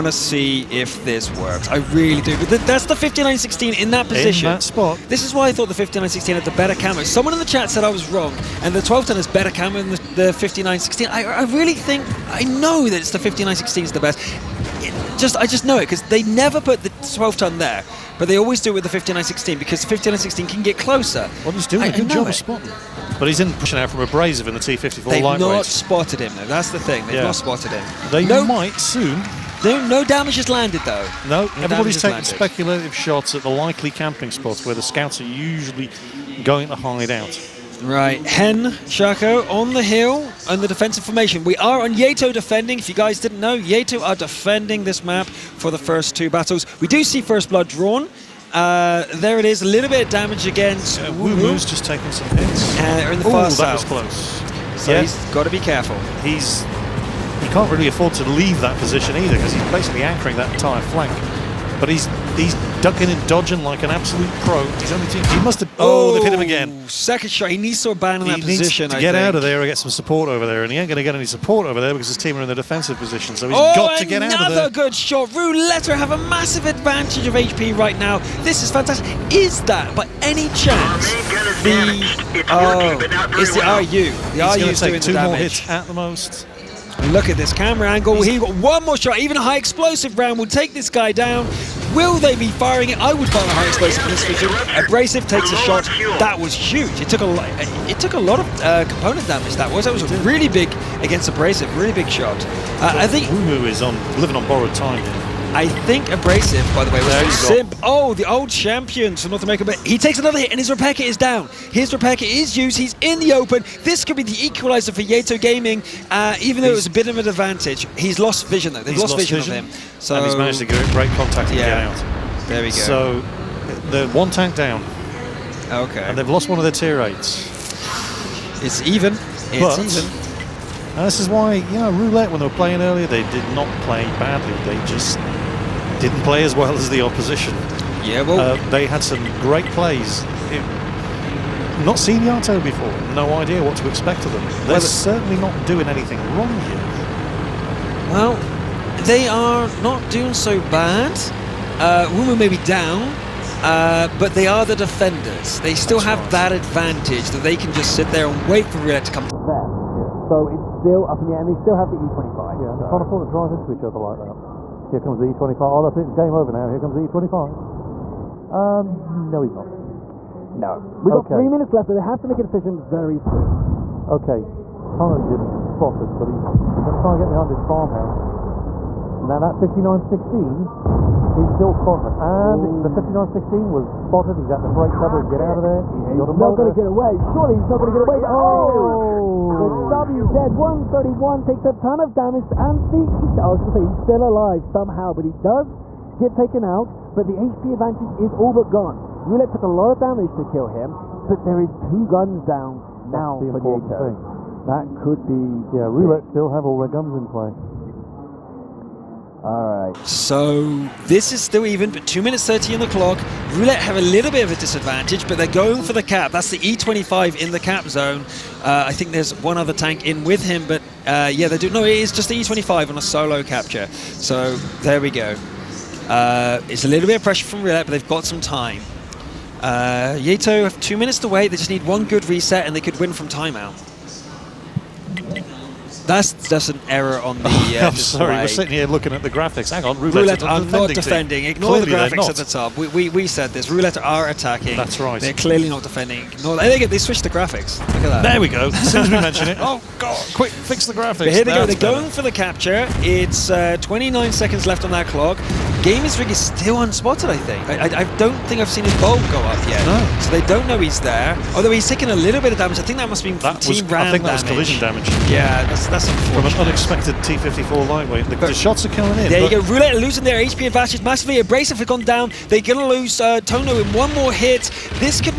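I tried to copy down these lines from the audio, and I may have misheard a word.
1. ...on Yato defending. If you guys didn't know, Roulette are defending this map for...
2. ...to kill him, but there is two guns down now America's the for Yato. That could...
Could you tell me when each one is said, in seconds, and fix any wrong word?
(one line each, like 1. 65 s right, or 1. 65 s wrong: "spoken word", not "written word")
1. 41 s wrong: "Yato", not "Roulette"
2. 200 s wrong: "That", not "America".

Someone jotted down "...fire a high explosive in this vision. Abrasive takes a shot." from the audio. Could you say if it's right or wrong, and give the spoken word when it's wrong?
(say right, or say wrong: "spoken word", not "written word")
right.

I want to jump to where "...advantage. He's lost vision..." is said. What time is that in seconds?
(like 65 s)
117 s.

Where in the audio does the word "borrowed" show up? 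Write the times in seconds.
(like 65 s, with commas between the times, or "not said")
104 s.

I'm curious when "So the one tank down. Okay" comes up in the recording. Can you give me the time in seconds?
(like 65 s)
122 s.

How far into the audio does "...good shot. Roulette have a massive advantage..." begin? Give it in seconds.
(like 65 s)
74 s.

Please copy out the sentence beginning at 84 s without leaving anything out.
The RU is doing two more hits at the most.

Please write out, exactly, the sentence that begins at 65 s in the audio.
Oh, oh, they've hit him again.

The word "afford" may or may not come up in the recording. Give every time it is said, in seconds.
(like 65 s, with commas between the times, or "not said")
57 s, 163 s.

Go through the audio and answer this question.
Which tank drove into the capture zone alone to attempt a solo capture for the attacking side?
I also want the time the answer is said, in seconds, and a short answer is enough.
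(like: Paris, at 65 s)
E25, at 216 s.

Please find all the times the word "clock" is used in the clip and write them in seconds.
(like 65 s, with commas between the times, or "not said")
212 s, 255 s.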